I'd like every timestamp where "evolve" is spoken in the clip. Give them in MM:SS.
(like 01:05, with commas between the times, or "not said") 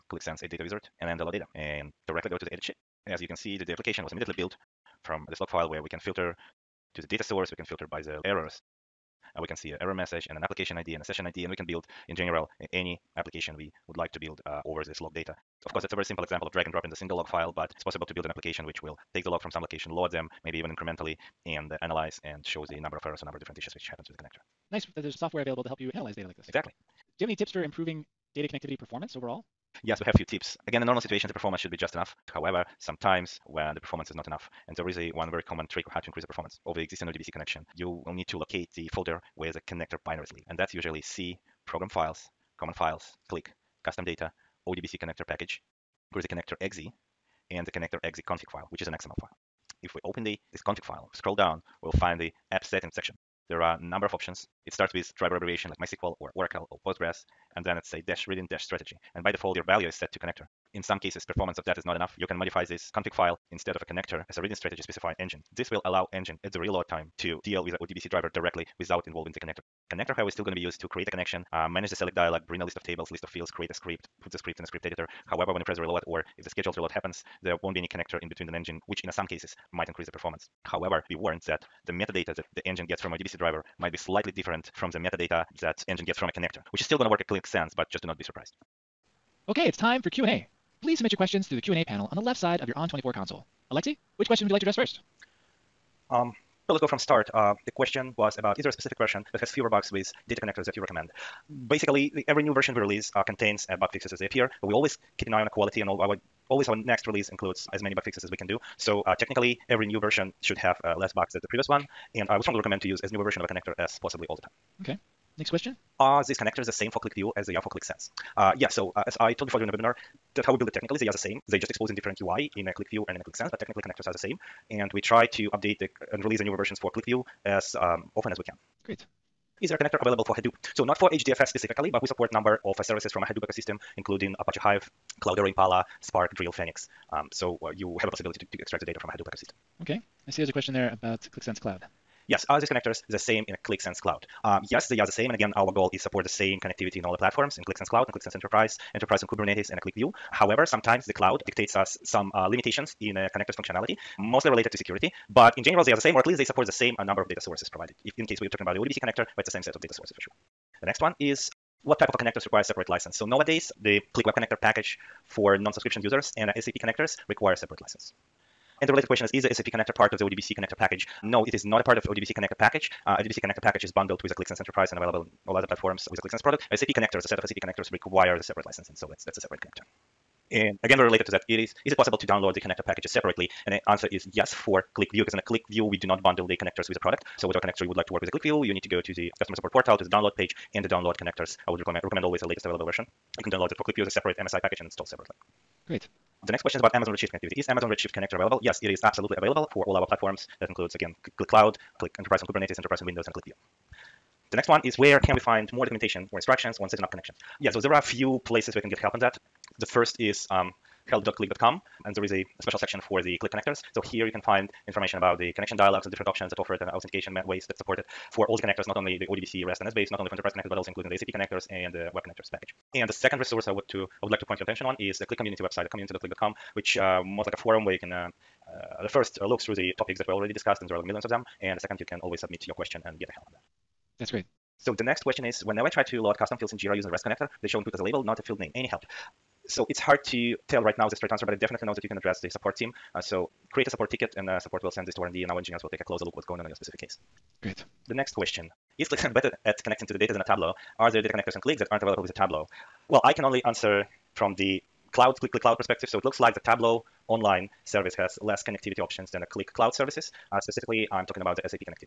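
not said.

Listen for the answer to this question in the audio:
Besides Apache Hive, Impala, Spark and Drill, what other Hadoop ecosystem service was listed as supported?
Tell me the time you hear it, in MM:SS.
02:16.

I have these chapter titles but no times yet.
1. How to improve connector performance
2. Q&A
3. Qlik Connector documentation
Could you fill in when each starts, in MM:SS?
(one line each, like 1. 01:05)
1. 00:29
2. 01:29
3. 03:27.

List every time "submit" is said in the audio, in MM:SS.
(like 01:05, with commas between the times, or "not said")
01:30, 03:52.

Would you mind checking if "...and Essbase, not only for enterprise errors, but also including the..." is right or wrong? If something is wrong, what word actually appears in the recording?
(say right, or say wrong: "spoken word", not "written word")
wrong: "connectors", not "errors".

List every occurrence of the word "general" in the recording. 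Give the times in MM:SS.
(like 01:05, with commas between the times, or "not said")
00:12, 02:35.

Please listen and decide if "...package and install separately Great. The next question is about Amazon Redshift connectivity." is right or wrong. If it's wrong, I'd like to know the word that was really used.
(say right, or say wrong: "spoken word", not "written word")
right.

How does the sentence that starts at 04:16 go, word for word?
So it looks like the Tableau online service has less connectivity options than the Qlik Cloud services.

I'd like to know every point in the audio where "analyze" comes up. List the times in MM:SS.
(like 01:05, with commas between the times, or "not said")
00:21, 00:25.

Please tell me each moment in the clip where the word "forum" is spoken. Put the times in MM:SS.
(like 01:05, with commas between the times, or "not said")
03:47.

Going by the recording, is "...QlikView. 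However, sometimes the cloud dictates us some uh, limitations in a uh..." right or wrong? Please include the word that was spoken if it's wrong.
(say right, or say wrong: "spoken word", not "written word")
right.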